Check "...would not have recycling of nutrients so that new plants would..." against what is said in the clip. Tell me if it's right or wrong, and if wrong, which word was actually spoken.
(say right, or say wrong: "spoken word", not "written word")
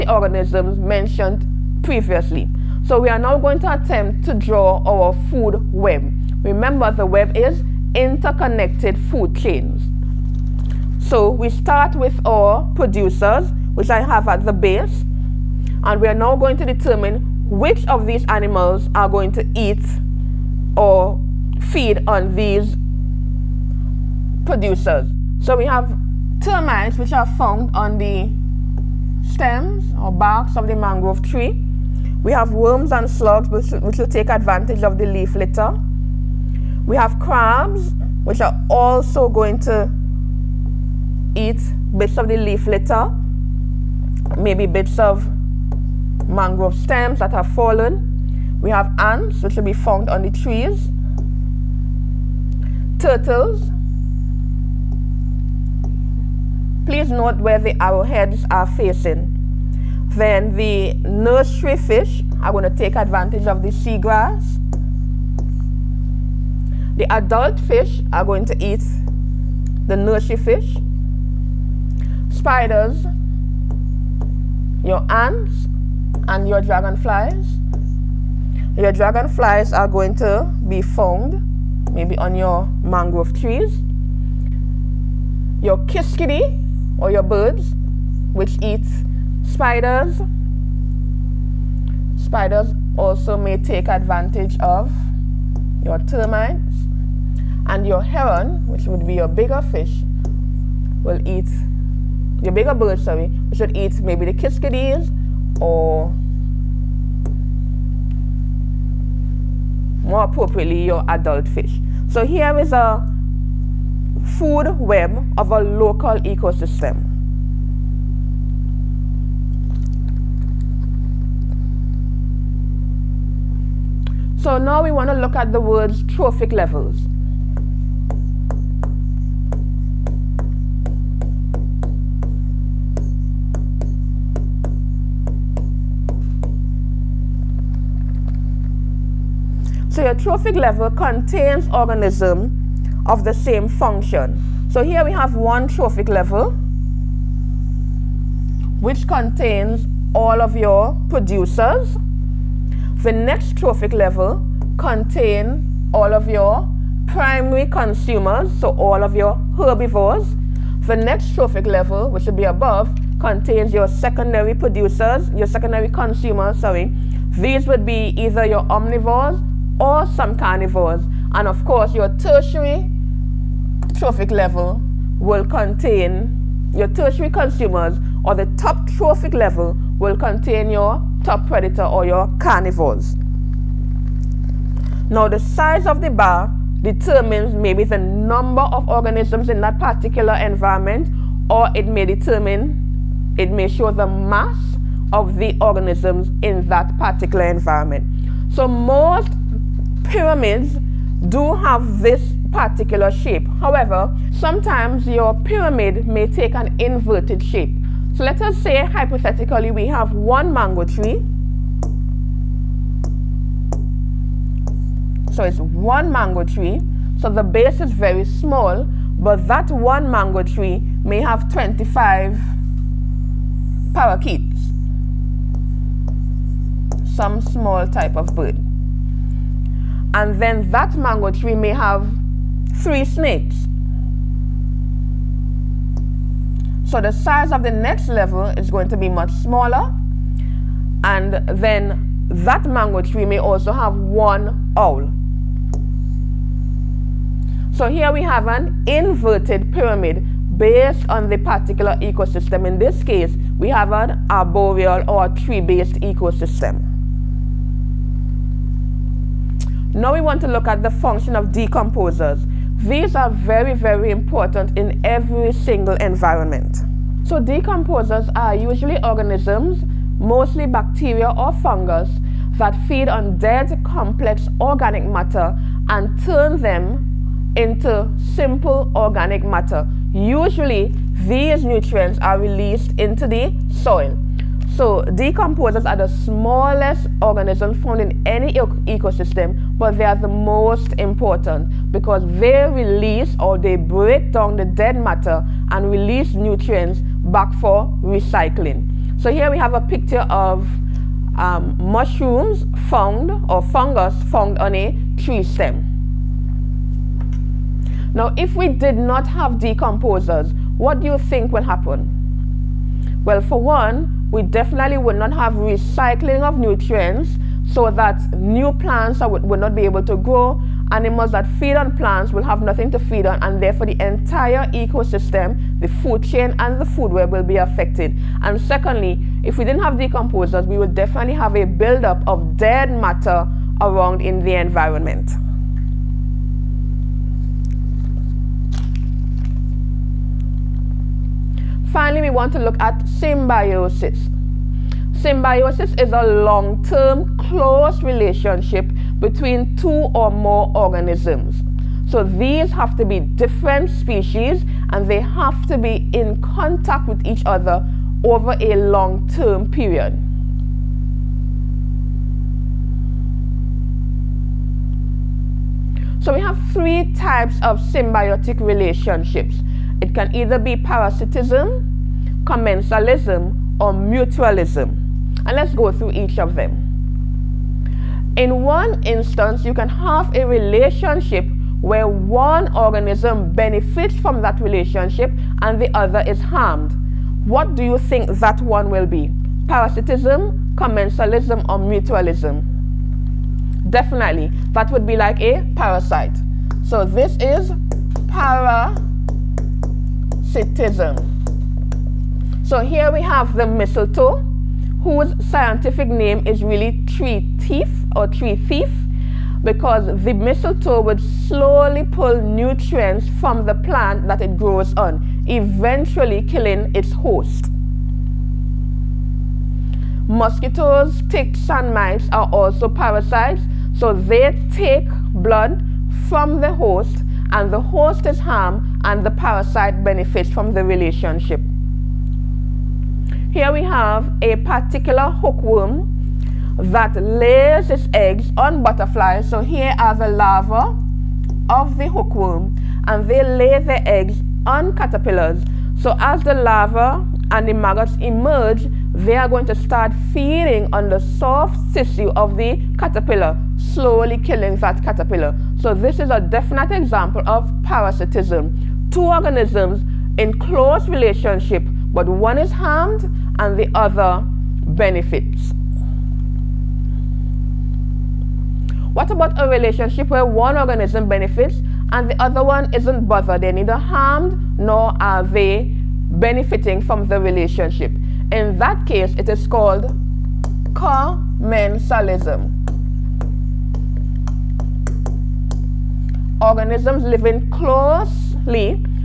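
right.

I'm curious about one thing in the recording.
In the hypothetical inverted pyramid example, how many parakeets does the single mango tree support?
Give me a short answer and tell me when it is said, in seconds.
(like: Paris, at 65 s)
25, at 221 s.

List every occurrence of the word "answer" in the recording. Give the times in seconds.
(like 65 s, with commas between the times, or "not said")
not said.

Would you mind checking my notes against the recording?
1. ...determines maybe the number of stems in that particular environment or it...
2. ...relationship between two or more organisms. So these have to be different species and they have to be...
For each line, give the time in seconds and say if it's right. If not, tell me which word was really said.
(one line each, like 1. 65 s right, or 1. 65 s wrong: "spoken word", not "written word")
1. 186 s wrong: "organisms", not "stems"
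2. 348 s right.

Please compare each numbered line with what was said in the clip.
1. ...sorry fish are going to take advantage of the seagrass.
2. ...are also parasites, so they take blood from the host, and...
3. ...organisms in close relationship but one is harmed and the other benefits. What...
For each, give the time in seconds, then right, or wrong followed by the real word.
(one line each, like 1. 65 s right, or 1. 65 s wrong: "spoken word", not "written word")
1. 61 s wrong: "nursery", not "sorry"
2. 422 s right
3. 459 s right.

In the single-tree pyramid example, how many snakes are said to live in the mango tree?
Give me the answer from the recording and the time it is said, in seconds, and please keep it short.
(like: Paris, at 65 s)
3, at 232 s.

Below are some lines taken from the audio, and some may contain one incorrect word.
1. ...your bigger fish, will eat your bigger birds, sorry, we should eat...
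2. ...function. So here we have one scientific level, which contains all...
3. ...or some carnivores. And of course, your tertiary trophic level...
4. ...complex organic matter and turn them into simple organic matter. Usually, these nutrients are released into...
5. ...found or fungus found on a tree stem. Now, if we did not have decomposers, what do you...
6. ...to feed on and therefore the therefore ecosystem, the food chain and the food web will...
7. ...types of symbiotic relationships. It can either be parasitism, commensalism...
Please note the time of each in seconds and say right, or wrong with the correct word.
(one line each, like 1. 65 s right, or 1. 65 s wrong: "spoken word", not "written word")
1. 99 s right
2. 143 s wrong: "trophic", not "scientific"
3. 169 s right
4. 273 s right
5. 302 s right
6. 322 s wrong: "entire", not "therefore"
7. 367 s right.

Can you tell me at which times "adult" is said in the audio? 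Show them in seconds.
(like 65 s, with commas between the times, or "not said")
67 s, 111 s.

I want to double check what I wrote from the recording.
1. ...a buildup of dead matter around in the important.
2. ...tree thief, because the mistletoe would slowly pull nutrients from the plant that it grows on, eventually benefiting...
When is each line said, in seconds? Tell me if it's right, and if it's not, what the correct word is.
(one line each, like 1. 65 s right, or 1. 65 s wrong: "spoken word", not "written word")
1. 331 s wrong: "environment", not "important"
2. 408 s wrong: "killing", not "benefiting".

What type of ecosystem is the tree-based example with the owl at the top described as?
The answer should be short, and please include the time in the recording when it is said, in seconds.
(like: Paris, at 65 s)
Arboreal, at 254 s.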